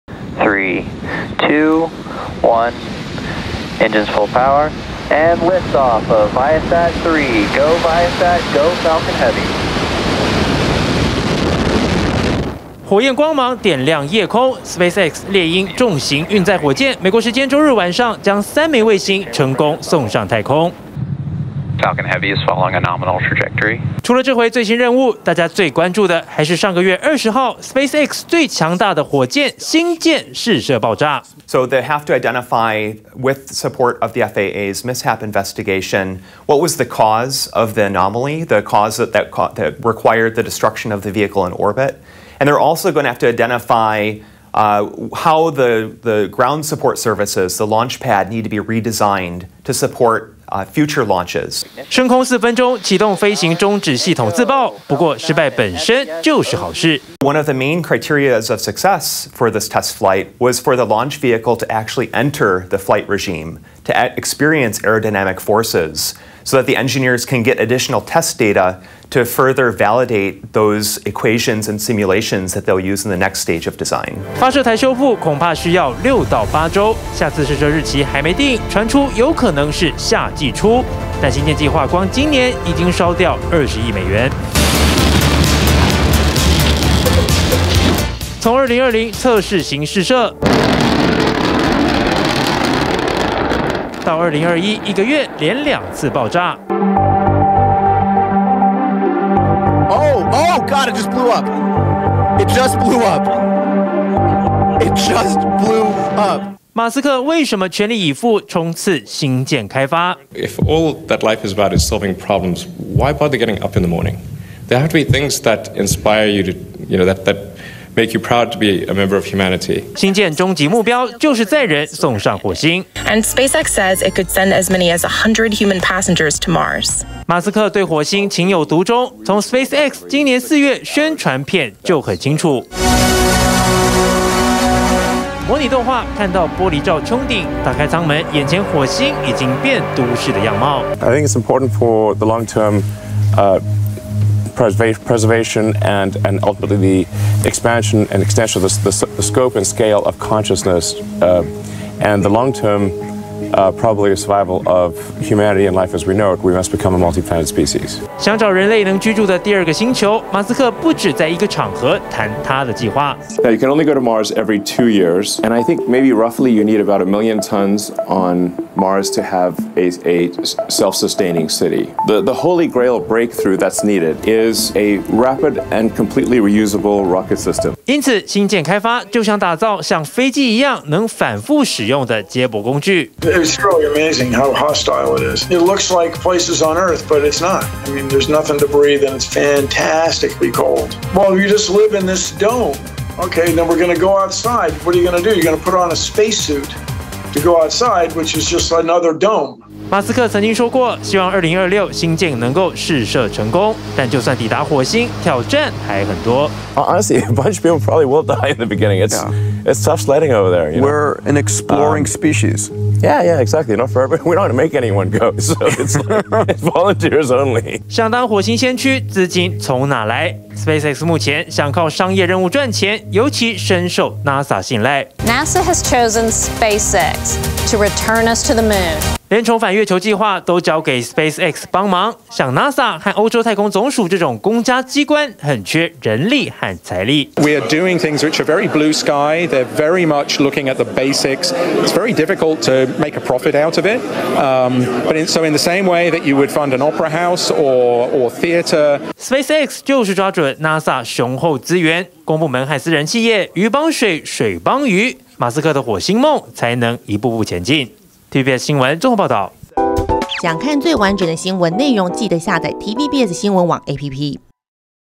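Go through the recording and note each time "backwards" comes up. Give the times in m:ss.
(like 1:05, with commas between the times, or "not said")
not said.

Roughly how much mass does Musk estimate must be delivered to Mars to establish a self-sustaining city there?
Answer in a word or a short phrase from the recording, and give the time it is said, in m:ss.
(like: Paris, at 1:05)
a million tons, at 2:47.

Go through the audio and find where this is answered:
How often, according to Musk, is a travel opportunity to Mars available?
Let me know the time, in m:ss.
2:44.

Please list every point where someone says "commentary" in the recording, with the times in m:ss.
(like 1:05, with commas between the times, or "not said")
not said.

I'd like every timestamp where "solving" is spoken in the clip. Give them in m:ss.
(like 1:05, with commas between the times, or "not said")
1:51.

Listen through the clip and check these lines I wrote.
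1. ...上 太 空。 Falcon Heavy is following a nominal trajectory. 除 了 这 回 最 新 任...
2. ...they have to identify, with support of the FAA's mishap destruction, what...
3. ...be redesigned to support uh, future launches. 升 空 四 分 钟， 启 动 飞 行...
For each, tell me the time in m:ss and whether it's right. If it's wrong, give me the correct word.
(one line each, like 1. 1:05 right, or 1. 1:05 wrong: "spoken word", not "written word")
1. 0:20 right
2. 0:31 wrong: "investigation", not "destruction"
3. 0:48 right.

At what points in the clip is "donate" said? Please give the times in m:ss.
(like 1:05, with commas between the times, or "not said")
not said.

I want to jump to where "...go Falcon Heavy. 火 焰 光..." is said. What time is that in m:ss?
0:08.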